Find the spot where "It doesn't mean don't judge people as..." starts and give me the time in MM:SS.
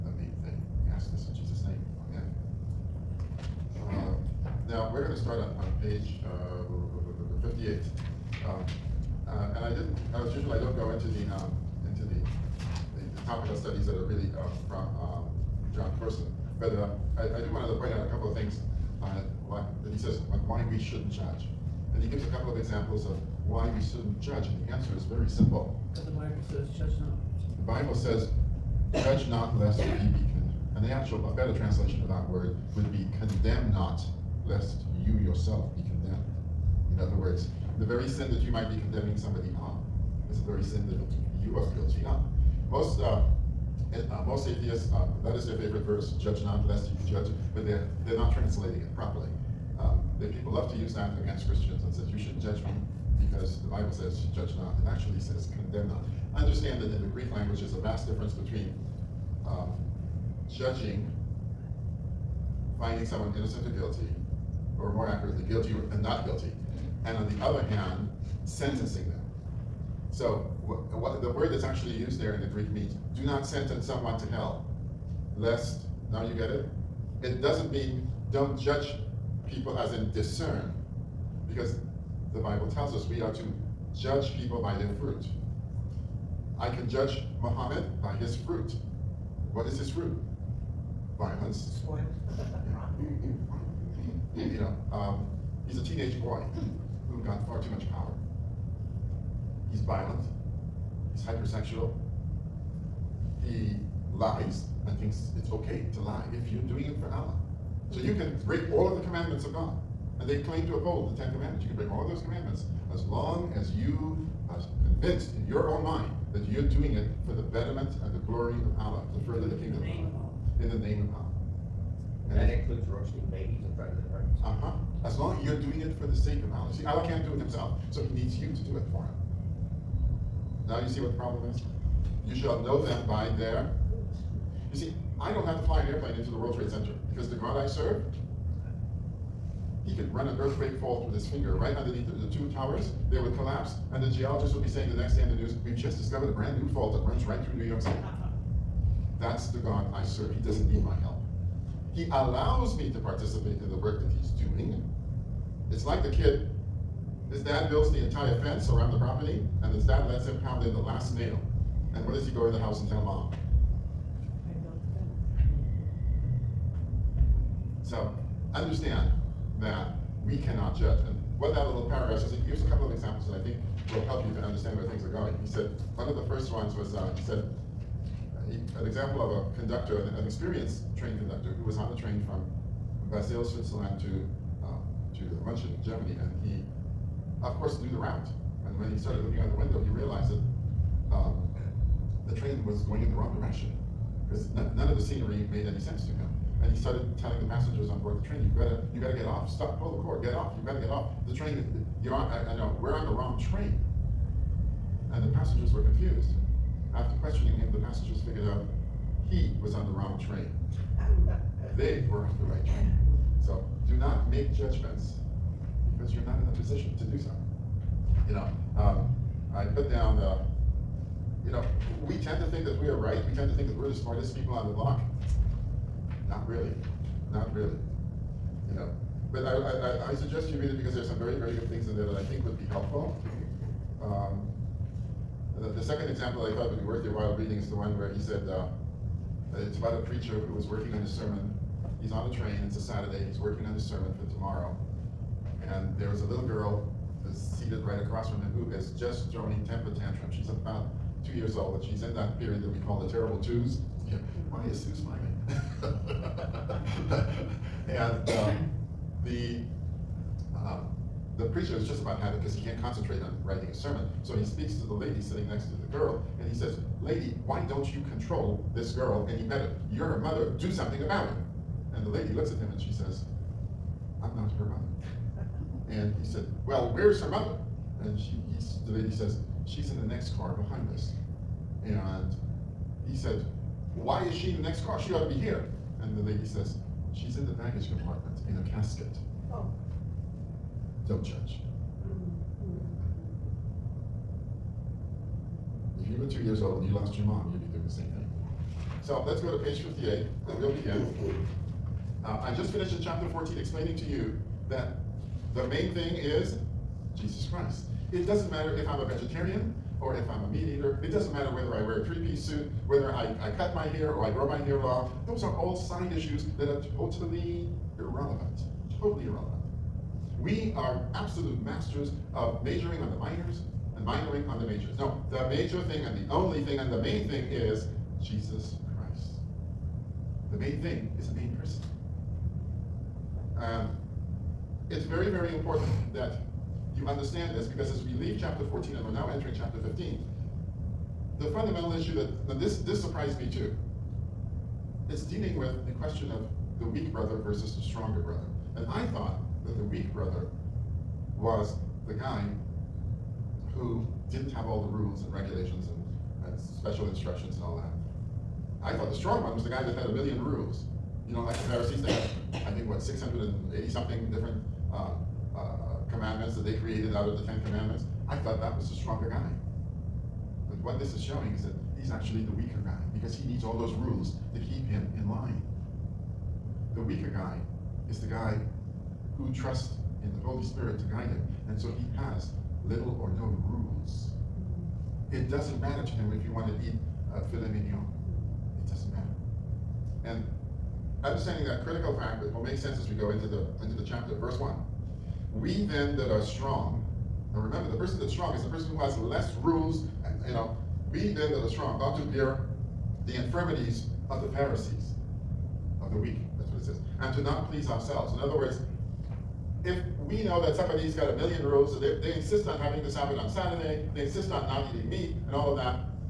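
01:17.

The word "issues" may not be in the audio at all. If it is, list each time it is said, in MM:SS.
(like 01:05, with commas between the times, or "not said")
05:16, 05:41.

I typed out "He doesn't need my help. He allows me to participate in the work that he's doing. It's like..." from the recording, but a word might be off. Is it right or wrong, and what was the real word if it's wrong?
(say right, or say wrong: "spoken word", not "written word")
right.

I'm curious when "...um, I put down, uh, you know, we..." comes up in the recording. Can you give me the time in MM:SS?
03:38.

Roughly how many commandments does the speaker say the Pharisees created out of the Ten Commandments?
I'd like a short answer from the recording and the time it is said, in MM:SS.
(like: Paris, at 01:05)
680, at 06:02.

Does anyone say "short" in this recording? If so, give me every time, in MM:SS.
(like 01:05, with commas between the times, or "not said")
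not said.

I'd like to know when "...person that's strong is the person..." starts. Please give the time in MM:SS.
06:37.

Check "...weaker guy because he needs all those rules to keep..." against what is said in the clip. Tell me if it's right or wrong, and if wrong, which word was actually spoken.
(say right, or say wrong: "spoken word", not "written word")
right.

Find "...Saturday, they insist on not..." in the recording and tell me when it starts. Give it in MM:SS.
06:53.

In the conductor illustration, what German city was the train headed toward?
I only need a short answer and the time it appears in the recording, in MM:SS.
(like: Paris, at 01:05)
München, at 03:05.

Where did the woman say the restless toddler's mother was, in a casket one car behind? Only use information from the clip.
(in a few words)
baggage compartment.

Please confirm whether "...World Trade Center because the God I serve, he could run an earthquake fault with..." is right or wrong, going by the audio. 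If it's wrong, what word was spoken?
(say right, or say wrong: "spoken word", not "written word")
right.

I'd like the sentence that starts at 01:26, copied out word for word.
I can judge Muhammad by his fruit.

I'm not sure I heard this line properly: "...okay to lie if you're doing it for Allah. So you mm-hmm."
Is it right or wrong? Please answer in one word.
right.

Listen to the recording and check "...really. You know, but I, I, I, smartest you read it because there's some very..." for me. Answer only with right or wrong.
wrong.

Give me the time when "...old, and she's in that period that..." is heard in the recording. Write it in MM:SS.
04:11.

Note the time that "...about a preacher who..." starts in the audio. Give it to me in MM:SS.
03:59.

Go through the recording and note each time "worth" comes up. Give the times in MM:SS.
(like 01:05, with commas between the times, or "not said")
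03:56.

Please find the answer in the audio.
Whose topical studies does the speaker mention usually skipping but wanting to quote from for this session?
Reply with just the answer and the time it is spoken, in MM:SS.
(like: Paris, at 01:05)
Jon Courson, at 00:15.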